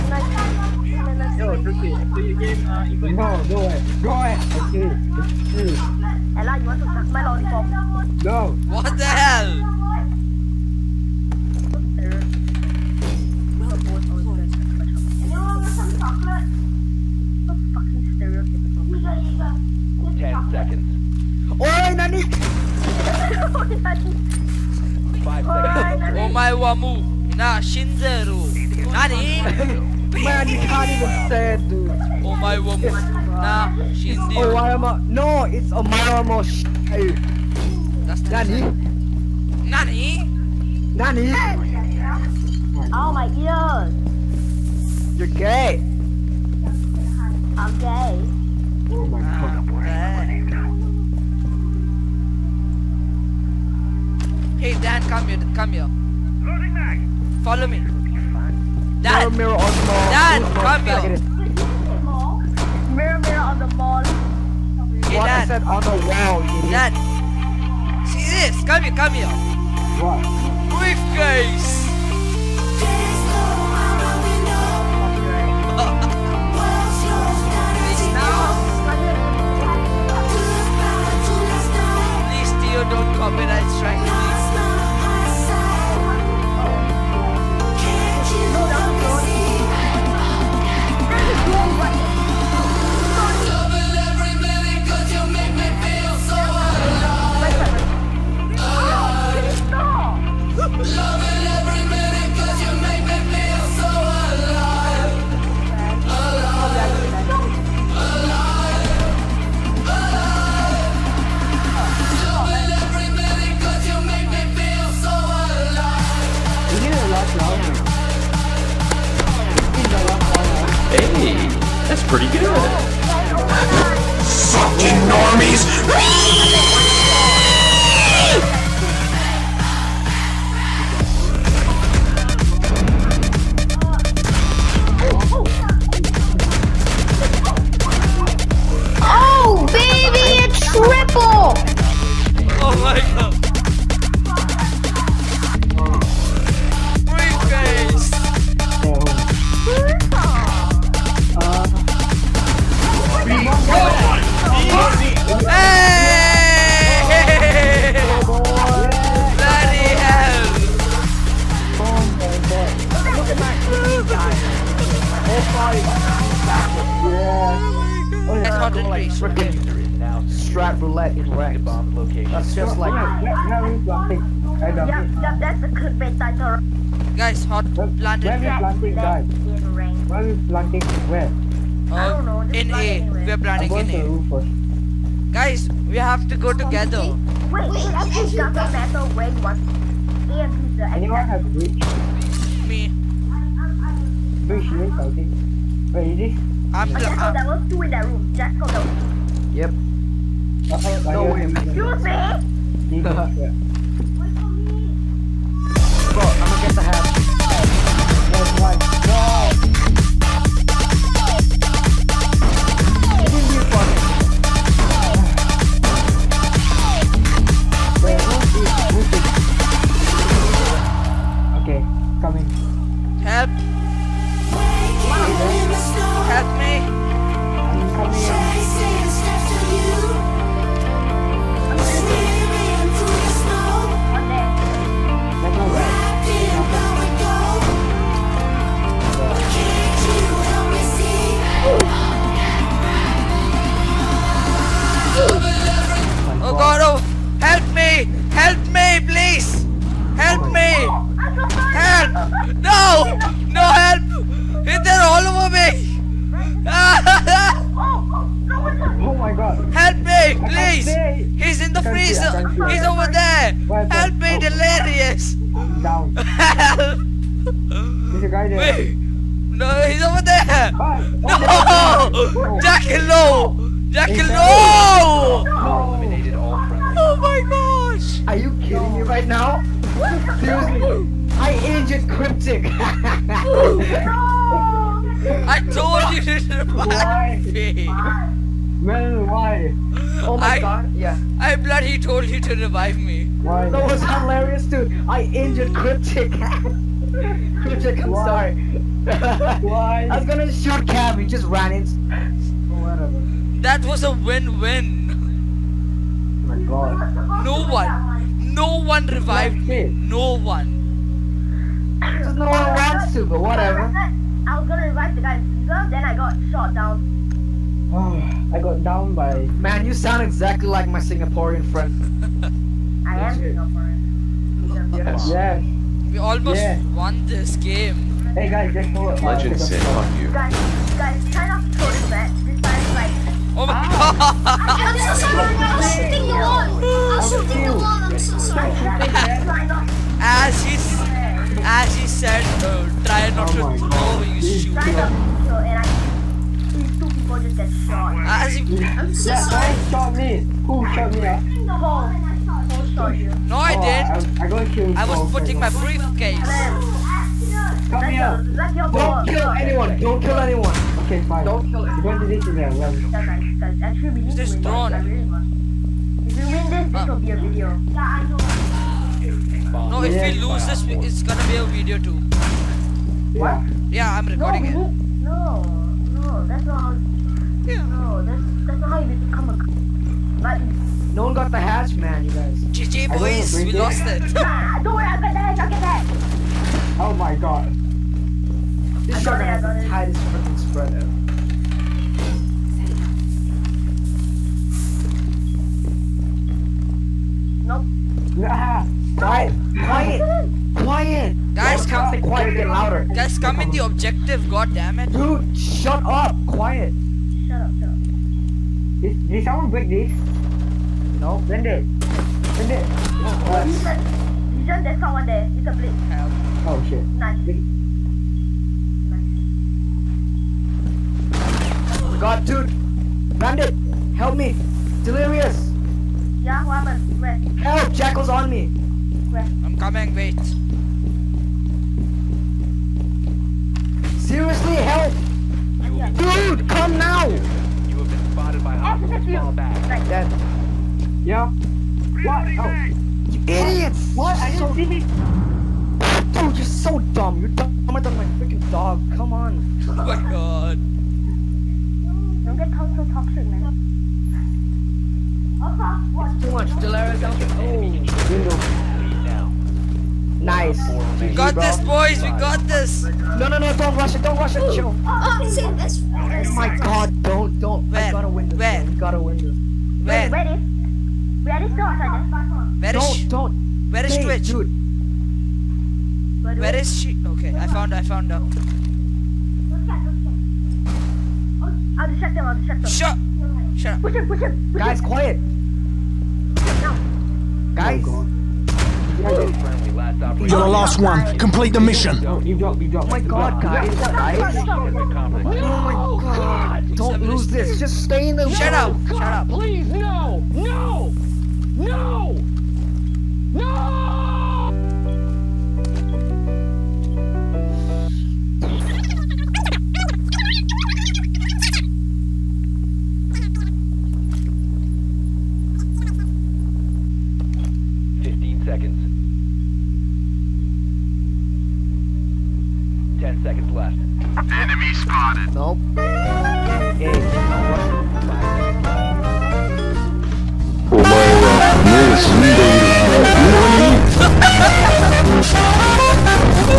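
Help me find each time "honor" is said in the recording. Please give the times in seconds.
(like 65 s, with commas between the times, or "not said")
not said.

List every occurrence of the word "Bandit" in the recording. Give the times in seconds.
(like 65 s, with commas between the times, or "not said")
423 s.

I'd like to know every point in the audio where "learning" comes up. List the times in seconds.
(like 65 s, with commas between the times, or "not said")
not said.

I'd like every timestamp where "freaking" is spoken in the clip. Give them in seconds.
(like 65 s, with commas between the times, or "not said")
169 s, 390 s, 448 s.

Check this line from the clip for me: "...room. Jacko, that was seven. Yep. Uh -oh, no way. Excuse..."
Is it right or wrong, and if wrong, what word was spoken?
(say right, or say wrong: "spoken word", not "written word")
wrong: "two", not "seven".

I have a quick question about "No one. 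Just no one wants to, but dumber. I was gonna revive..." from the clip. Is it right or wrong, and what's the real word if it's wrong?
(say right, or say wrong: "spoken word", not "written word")
wrong: "whatever", not "dumber".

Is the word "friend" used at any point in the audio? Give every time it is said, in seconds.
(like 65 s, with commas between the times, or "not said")
321 s.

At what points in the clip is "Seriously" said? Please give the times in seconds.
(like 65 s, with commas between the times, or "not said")
280 s, 434 s.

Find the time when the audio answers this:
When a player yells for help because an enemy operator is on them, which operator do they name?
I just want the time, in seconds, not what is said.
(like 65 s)
427 s.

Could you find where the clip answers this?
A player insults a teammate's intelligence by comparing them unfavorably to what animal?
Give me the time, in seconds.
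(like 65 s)
448 s.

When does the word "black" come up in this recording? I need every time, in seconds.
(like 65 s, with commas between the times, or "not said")
not said.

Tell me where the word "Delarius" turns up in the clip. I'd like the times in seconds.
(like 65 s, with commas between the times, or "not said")
456 s.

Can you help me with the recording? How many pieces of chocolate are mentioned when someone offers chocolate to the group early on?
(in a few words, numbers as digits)
10.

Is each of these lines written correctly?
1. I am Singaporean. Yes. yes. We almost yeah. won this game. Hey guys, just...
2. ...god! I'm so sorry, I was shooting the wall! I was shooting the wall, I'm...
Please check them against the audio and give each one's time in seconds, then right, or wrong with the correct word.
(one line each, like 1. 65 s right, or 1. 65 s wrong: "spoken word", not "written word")
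1. 323 s right
2. 334 s right.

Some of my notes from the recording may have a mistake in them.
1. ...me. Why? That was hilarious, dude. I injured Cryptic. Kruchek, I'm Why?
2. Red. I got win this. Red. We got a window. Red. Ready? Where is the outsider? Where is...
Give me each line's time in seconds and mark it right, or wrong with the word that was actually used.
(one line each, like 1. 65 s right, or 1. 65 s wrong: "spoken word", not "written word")
1. 292 s right
2. 467 s right.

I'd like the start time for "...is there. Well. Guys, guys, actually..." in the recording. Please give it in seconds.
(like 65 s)
362 s.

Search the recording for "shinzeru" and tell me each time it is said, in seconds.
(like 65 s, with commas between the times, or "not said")
27 s, 33 s.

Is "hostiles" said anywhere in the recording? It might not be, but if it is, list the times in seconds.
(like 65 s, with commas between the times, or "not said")
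438 s.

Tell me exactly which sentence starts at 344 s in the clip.
Try not to throw, and I these two people just get shot.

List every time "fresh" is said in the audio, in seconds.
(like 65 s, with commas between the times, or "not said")
not said.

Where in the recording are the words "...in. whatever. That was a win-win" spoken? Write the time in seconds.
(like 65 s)
301 s.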